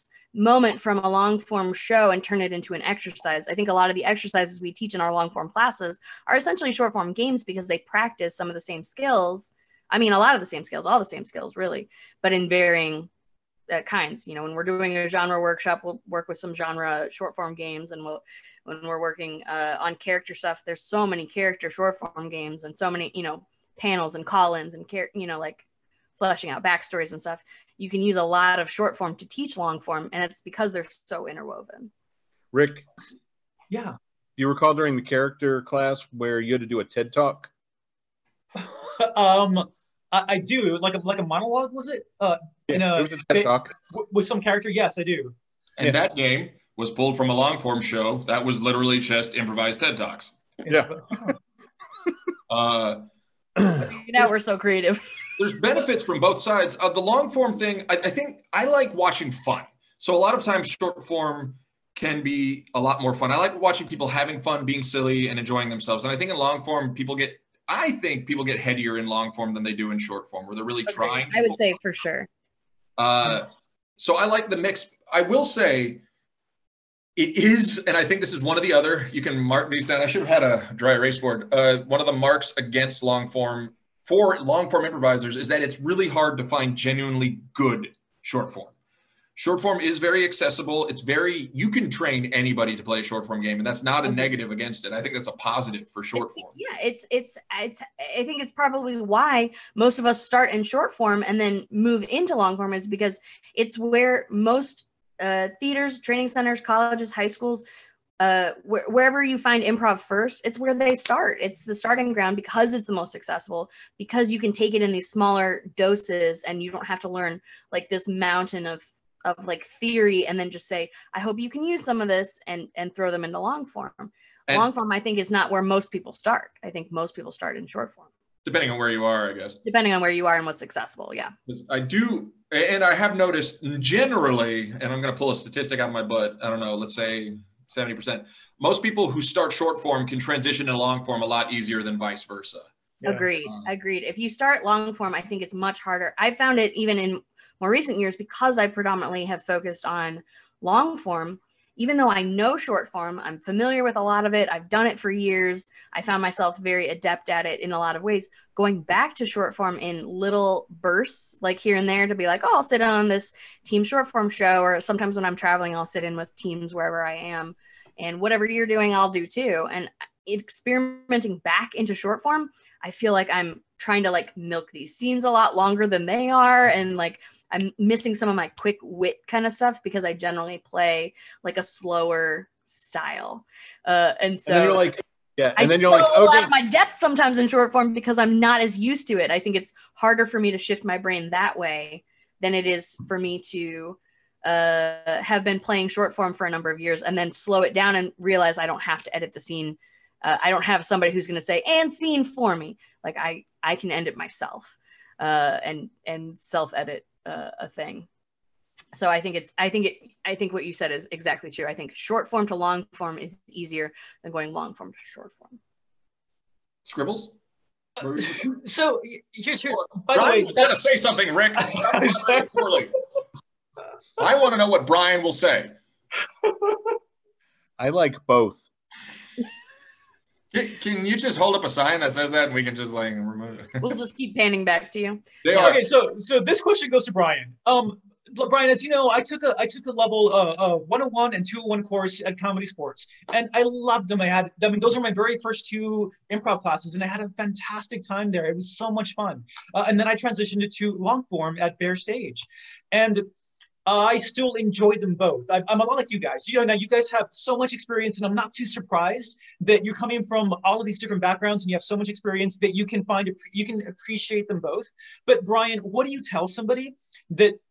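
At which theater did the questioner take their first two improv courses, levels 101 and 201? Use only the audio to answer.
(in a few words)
ComedySportz.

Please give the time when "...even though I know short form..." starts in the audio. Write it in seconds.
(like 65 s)
151 s.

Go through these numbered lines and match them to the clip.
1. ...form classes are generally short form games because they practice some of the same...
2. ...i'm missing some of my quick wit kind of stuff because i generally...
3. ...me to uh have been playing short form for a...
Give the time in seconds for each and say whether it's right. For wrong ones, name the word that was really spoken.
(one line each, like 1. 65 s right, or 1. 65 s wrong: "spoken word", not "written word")
1. 5 s wrong: "essentially", not "generally"
2. 177 s right
3. 193 s right.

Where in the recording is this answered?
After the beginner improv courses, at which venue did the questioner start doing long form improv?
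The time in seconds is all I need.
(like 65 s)
251 s.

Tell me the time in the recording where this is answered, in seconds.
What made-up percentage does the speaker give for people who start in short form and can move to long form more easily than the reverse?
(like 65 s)
137 s.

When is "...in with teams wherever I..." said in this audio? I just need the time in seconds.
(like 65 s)
166 s.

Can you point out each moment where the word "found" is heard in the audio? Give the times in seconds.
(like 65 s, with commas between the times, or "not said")
146 s, 156 s.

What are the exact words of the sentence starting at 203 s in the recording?
Like I I can end it myself uh, and and self edit uh, a thing.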